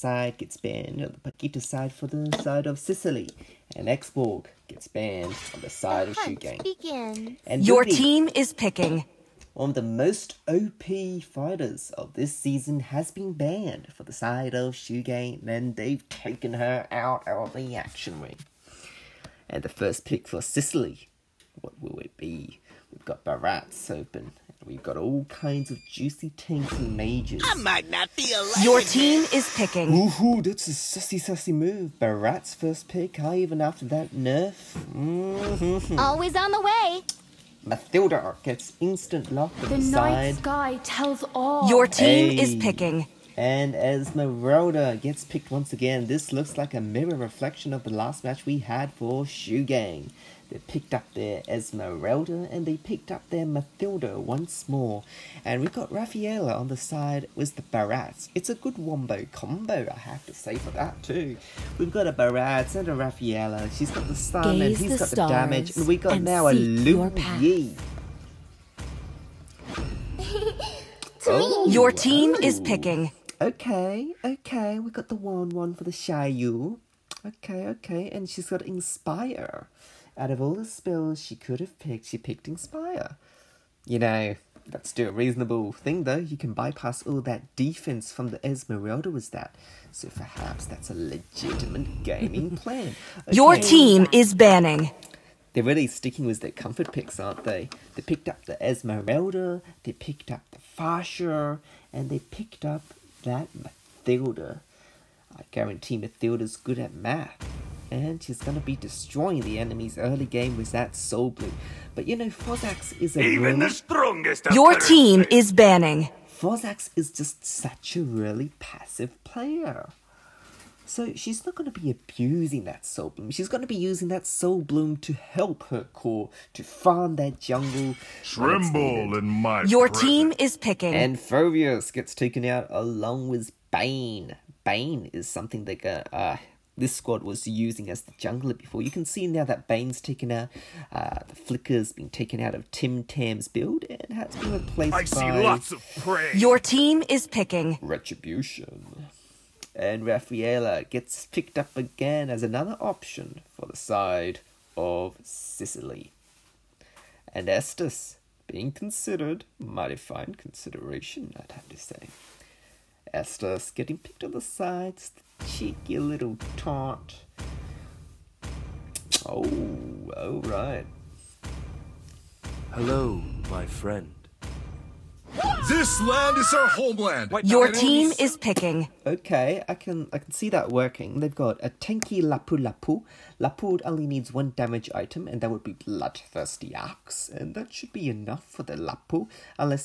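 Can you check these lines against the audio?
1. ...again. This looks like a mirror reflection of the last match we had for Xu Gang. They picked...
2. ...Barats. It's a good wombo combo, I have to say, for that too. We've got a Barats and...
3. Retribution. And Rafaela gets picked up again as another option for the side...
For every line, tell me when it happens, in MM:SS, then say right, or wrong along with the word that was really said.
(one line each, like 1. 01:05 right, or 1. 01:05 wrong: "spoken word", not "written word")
1. 00:45 right
2. 00:57 right
3. 02:27 right.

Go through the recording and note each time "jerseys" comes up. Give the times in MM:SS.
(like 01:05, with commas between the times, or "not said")
not said.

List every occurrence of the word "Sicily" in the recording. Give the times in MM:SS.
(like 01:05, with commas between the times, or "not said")
00:02, 00:20, 02:35.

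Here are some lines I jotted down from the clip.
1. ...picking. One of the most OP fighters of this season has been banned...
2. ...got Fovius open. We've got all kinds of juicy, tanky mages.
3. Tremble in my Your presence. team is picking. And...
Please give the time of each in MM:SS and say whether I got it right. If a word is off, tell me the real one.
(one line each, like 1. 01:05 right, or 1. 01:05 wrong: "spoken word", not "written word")
1. 00:08 right
2. 00:23 wrong: "Barats", not "Fovius"
3. 02:08 right.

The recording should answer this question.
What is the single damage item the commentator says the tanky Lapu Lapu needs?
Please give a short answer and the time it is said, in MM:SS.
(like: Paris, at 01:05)
Bloodthirsty Axe, at 03:05.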